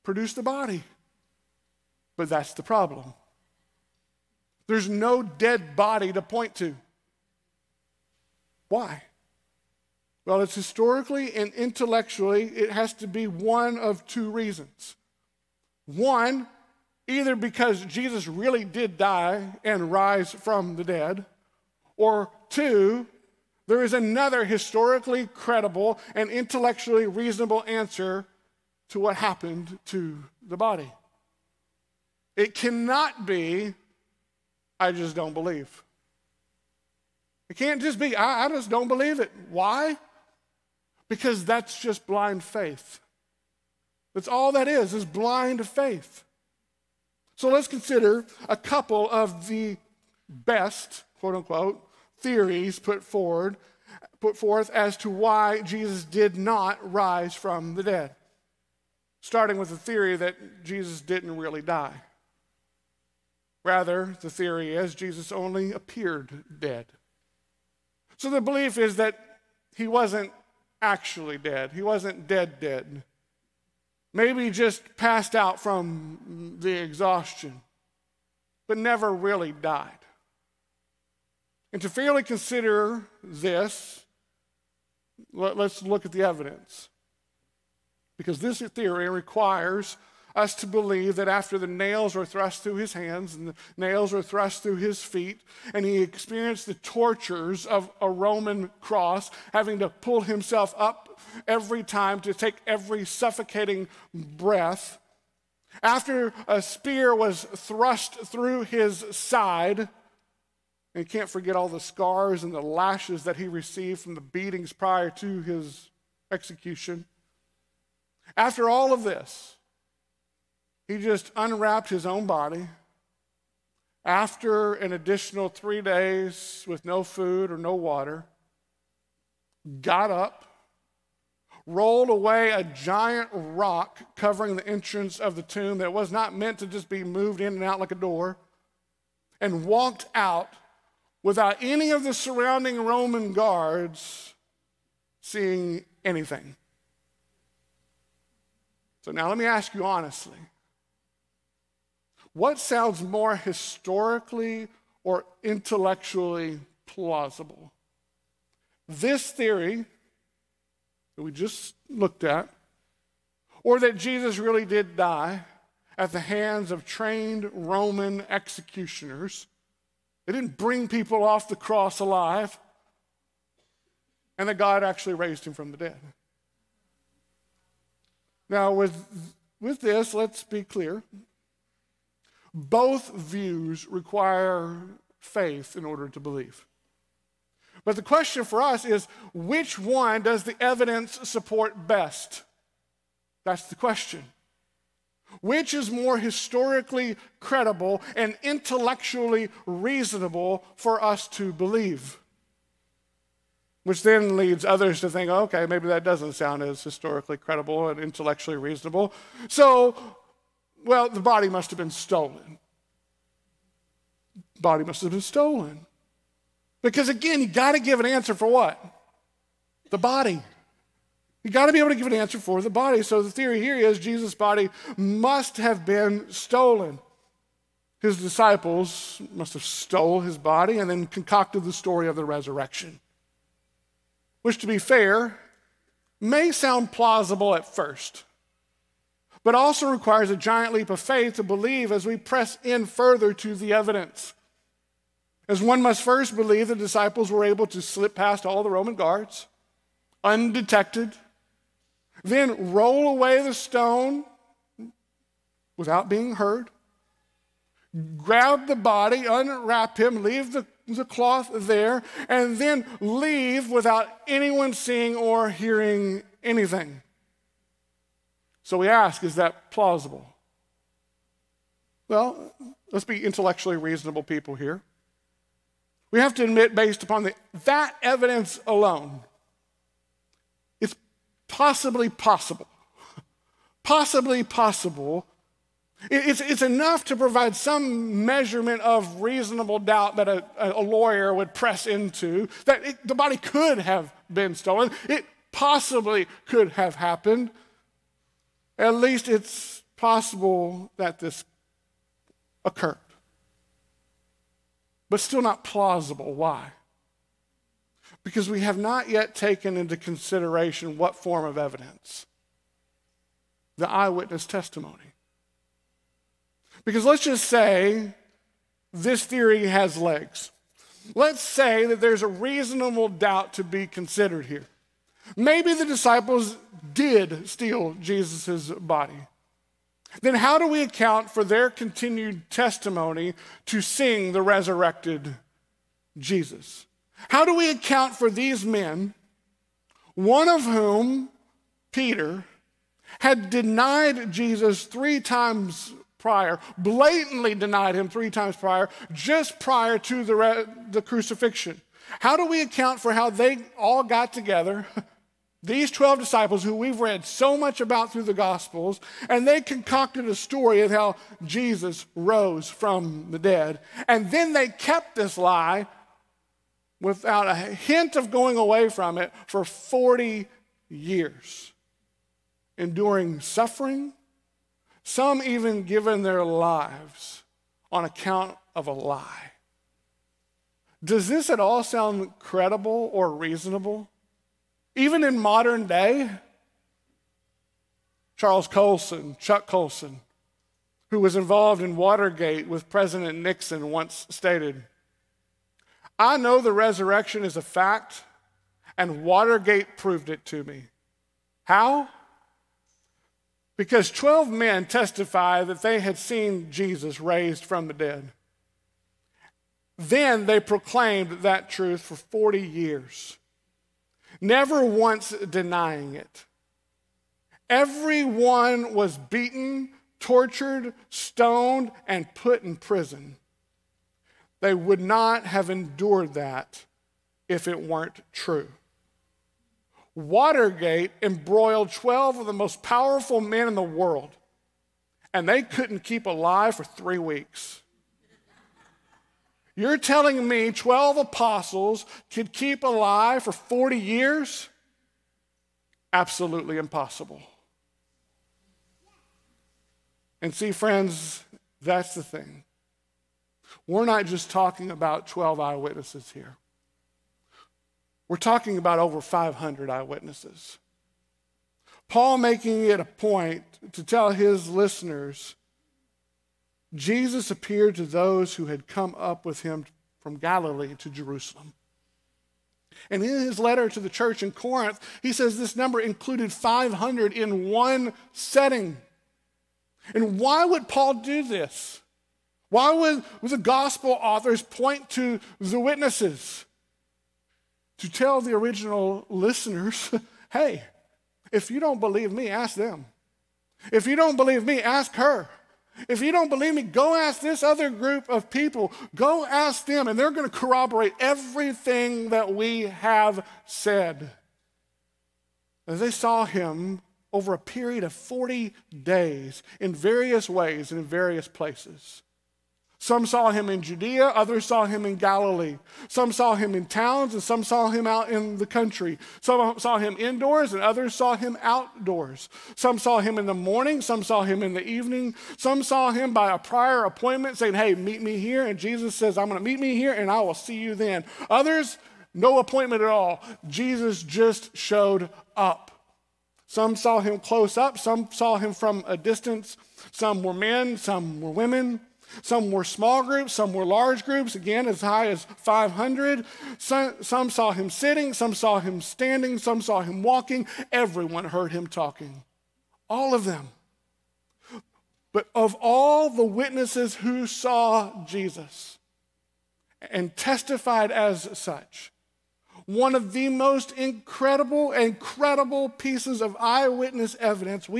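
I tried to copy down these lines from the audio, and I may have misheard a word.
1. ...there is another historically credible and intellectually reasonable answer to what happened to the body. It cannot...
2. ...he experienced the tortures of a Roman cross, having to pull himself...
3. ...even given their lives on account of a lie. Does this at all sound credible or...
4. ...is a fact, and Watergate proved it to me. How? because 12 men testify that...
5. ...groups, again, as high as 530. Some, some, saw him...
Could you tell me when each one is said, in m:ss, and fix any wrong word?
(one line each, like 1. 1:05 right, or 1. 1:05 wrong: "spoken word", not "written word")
1. 0:23 right
2. 1:35 right
3. 6:15 right
4. 6:37 right
5. 9:04 wrong: "500", not "530".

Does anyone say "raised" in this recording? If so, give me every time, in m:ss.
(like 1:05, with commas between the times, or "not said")
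2:55, 6:47.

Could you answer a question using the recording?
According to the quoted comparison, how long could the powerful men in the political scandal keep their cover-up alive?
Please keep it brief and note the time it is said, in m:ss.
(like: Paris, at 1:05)
3 weeks, at 7:16.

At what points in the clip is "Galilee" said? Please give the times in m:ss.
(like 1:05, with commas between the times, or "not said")
7:50, 8:35.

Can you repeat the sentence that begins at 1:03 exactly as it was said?
Rather, the theory is Jesus only appeared dead.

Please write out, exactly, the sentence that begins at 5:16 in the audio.
Because let's just say this theory has legs.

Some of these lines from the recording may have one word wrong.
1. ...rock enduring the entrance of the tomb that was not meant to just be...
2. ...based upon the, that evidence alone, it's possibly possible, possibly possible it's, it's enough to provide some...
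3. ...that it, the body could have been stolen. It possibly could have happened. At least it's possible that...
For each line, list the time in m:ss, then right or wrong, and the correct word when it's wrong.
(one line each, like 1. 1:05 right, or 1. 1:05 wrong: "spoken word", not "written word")
1. 2:13 wrong: "covering", not "enduring"
2. 4:36 right
3. 4:52 right.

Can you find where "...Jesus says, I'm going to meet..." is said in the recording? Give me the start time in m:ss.
8:48.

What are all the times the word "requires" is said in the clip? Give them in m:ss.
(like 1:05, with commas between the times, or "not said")
1:29, 3:03, 3:59.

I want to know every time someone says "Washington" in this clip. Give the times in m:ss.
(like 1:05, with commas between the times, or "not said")
not said.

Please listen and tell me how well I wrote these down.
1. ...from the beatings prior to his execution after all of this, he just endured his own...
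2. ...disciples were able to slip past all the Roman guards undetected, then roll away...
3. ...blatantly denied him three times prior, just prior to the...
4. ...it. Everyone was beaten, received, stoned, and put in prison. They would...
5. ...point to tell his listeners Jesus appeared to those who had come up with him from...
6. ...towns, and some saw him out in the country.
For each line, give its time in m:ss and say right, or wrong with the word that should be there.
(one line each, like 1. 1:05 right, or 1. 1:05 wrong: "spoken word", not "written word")
1. 1:54 wrong: "unwrapped", not "endured"
2. 4:06 right
3. 5:46 right
4. 6:56 wrong: "tortured", not "received"
5. 7:43 right
6. 8:36 right.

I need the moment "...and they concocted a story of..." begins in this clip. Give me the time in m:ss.
5:59.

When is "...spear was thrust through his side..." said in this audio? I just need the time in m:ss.
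1:46.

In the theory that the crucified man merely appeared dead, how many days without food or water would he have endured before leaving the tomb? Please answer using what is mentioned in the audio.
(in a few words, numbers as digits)
3.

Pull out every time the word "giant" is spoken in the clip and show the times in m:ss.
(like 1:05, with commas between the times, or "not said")
2:12, 4:00.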